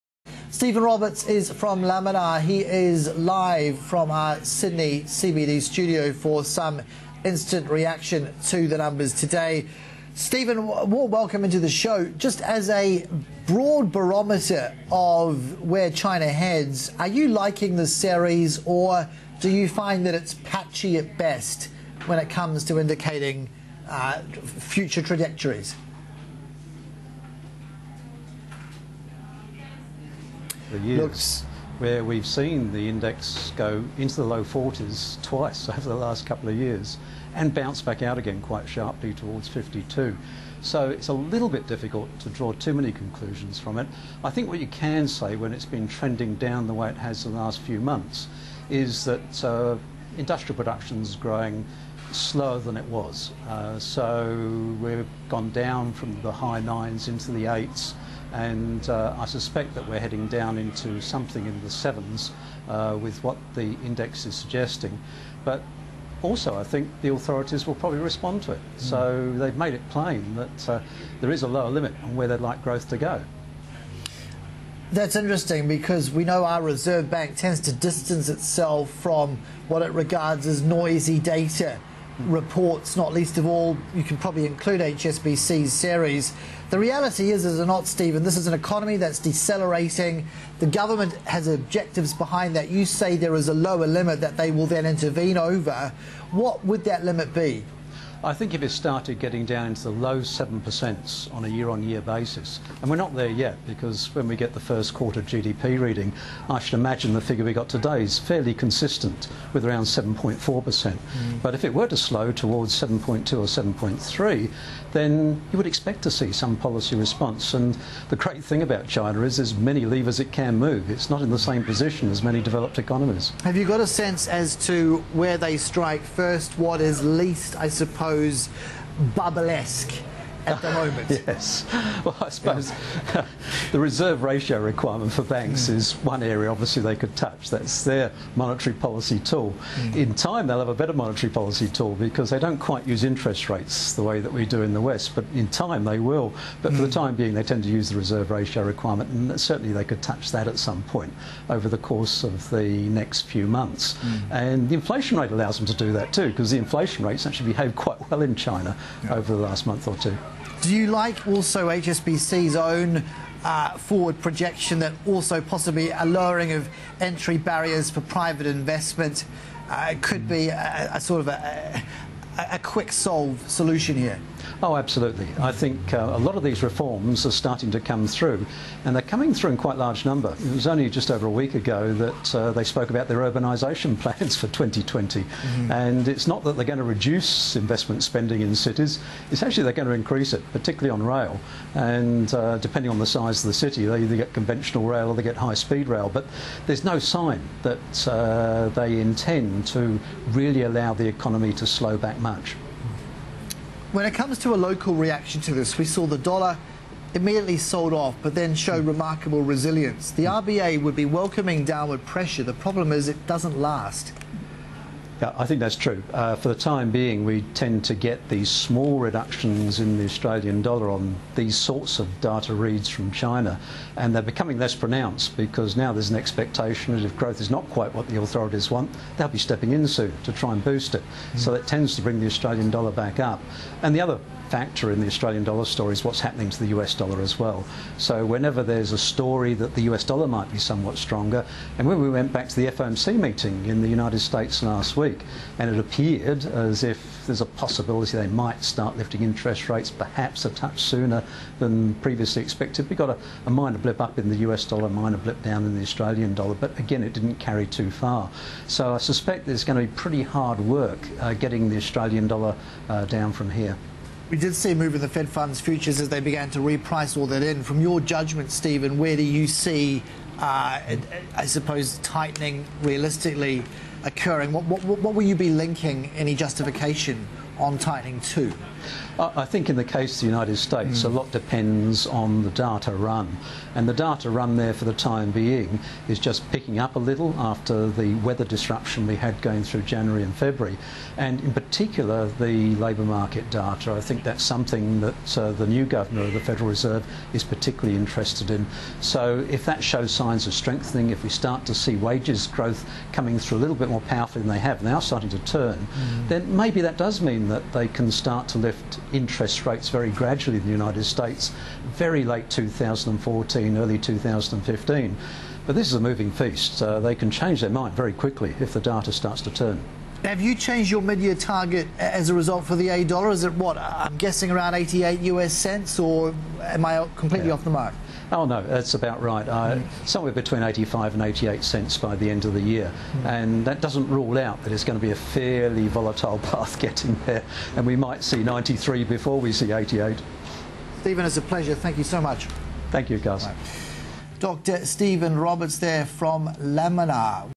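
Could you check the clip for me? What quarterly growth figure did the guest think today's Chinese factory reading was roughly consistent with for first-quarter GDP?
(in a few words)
7.4%.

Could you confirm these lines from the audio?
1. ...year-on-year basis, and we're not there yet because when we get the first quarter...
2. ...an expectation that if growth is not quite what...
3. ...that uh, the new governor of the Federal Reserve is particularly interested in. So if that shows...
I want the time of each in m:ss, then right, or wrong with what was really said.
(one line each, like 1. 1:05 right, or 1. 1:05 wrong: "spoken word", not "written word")
1. 1:41 right
2. 3:46 right
3. 4:55 right.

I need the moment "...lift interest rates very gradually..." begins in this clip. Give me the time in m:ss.
5:08.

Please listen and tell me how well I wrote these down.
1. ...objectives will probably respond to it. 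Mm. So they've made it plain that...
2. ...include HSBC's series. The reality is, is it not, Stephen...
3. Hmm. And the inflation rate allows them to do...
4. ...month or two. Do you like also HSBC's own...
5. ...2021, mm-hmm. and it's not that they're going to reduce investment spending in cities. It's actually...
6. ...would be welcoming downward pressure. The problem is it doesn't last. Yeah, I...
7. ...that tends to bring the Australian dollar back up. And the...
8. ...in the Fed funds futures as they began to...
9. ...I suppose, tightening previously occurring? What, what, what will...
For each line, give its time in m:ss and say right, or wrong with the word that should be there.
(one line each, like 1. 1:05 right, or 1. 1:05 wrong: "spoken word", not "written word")
1. 1:07 wrong: "authorities", not "objectives"
2. 1:24 right
3. 2:34 right
4. 2:39 right
5. 3:04 wrong: "2020", not "2021"
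6. 3:30 right
7. 3:51 right
8. 4:24 right
9. 4:31 wrong: "realistically", not "previously".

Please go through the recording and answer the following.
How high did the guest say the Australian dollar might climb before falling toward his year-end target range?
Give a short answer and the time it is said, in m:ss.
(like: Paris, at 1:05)
93 cents, at 5:38.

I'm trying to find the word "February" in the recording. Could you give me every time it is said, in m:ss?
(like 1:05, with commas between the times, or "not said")
4:50.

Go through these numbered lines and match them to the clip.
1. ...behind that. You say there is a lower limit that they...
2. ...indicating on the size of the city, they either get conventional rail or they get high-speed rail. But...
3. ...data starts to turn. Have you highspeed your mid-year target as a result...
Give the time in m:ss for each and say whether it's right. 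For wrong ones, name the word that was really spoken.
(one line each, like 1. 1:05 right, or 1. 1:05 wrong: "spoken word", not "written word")
1. 1:32 right
2. 3:12 wrong: "depending", not "indicating"
3. 5:18 wrong: "changed", not "highspeed".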